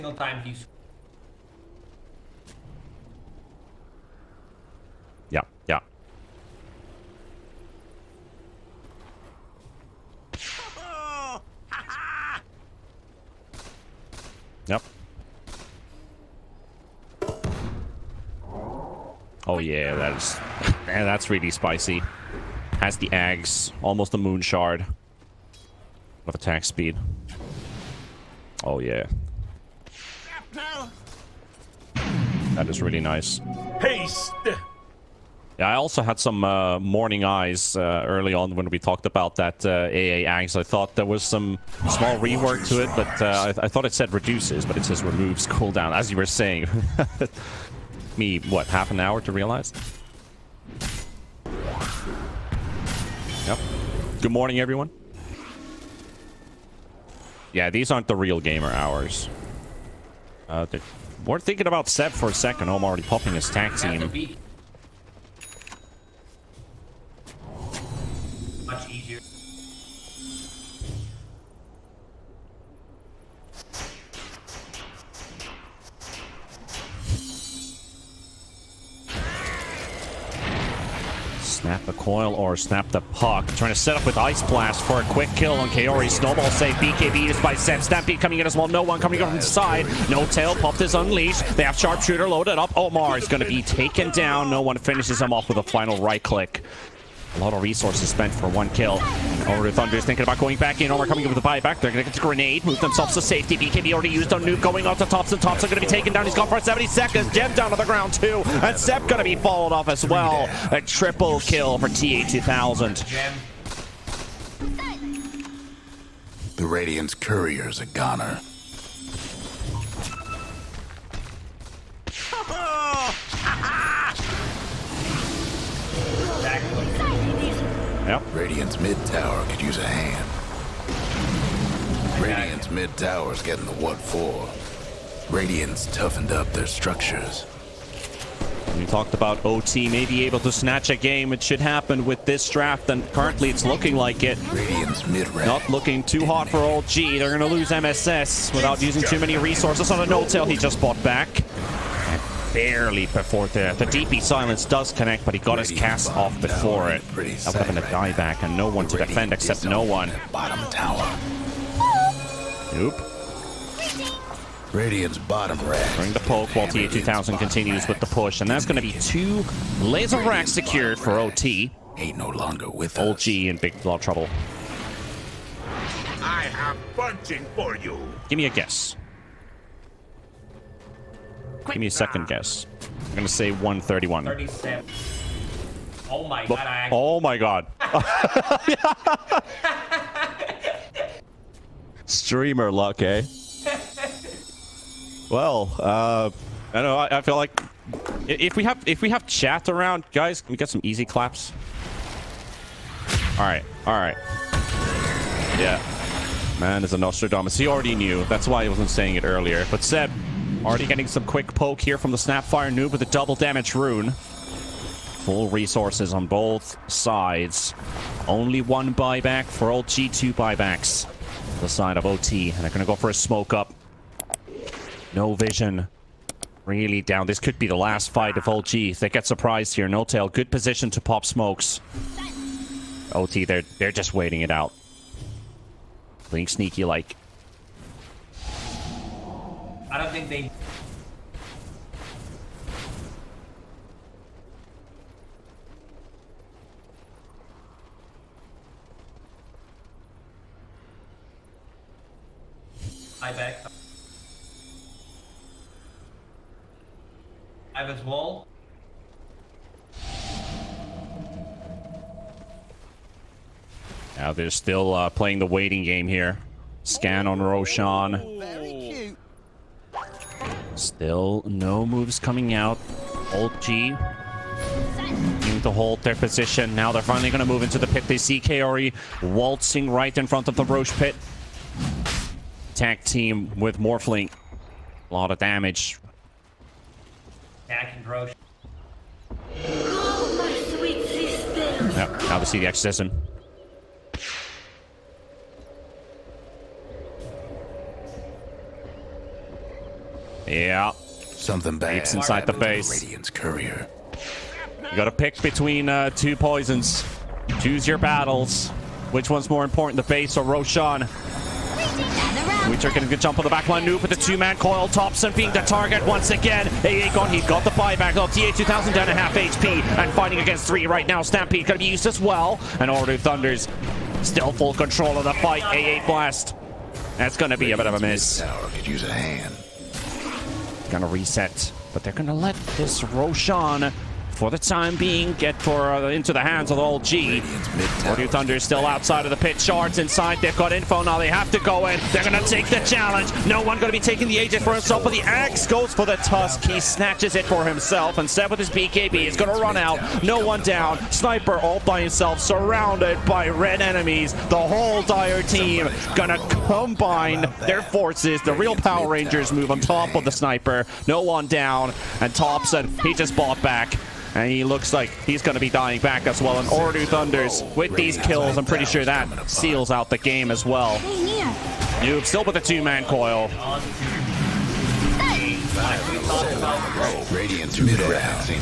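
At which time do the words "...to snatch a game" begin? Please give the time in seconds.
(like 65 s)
140 s.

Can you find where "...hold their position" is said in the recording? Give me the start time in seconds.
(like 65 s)
275 s.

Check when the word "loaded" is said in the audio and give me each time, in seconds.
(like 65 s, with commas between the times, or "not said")
92 s.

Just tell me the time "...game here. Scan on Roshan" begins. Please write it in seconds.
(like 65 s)
265 s.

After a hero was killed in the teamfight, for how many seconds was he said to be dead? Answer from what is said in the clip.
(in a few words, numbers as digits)
70 seconds.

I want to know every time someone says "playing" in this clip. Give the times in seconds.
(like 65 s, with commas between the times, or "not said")
236 s, 265 s.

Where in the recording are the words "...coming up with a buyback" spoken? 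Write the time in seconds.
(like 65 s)
101 s.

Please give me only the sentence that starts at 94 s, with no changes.
No one finishes him off with a final right click.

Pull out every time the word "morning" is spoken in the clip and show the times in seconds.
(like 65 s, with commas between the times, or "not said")
36 s, 54 s.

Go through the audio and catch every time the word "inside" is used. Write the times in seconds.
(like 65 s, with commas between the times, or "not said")
302 s, 339 s.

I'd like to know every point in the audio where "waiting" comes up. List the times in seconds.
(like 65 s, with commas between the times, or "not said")
234 s, 265 s.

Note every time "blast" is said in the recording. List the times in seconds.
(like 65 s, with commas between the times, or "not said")
84 s, 326 s.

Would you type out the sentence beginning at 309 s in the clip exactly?
Which one's more important, the base or Roshan?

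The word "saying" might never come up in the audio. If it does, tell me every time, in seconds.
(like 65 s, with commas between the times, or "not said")
46 s, 208 s.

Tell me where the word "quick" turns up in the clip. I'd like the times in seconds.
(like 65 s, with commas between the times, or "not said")
85 s, 211 s.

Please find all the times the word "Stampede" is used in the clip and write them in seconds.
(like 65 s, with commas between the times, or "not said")
87 s, 321 s.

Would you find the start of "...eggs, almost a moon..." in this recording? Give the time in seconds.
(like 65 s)
23 s.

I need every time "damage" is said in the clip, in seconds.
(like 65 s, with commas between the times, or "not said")
213 s, 285 s.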